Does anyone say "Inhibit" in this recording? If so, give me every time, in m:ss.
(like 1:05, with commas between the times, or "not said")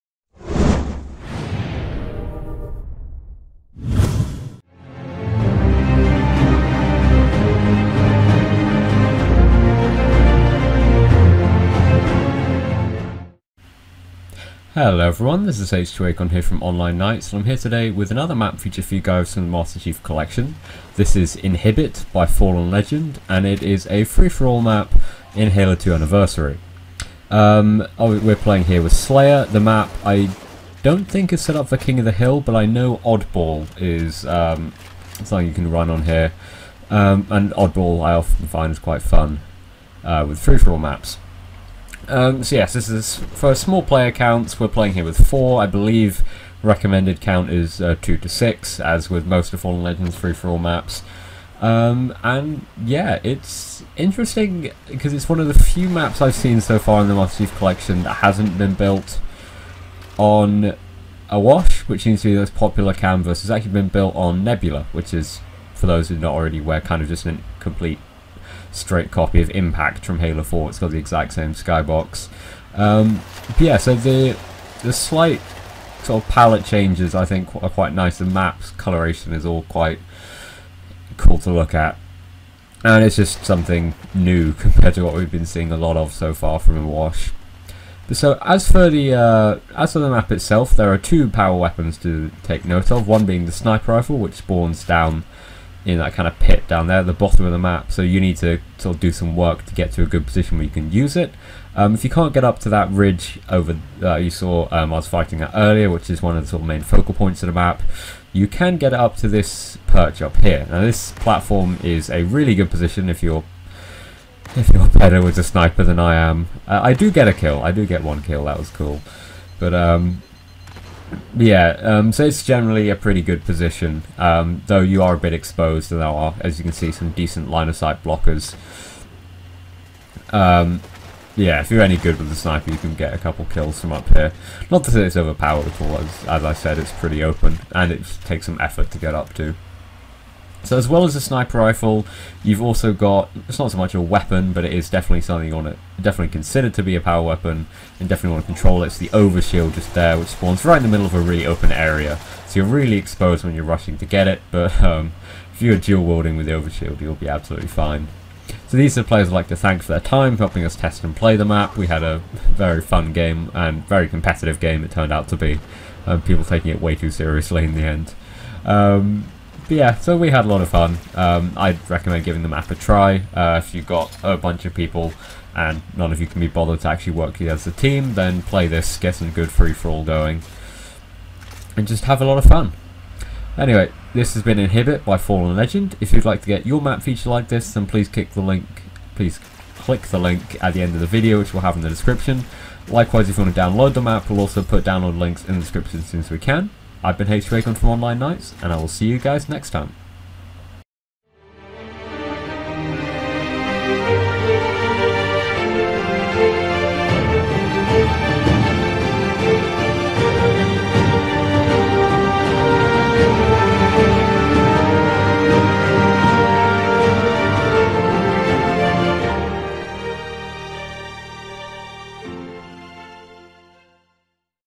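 0:21, 3:04.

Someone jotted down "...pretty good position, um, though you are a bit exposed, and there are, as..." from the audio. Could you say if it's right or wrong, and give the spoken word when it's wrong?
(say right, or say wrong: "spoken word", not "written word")
right.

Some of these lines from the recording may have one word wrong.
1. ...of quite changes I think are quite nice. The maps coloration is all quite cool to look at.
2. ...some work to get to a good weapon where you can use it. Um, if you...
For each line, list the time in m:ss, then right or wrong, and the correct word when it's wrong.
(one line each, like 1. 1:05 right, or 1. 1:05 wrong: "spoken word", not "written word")
1. 1:16 wrong: "palette", not "quite"
2. 1:39 wrong: "position", not "weapon".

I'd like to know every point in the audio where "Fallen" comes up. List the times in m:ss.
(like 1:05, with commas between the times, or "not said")
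0:22, 0:49, 3:05.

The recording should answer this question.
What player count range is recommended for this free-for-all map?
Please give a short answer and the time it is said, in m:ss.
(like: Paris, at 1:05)
2 to 6, at 0:48.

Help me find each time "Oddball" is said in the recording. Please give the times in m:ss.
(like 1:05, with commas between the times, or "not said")
0:33, 0:37.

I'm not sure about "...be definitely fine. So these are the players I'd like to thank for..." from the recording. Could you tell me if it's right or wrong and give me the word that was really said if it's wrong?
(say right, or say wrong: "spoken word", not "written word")
wrong: "absolutely", not "definitely".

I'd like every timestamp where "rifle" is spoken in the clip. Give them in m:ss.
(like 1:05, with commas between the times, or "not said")
1:33, 2:21.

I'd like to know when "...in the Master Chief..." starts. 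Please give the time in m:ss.
0:57.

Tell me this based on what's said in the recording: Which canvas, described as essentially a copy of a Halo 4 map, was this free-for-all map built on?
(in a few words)
Nebula.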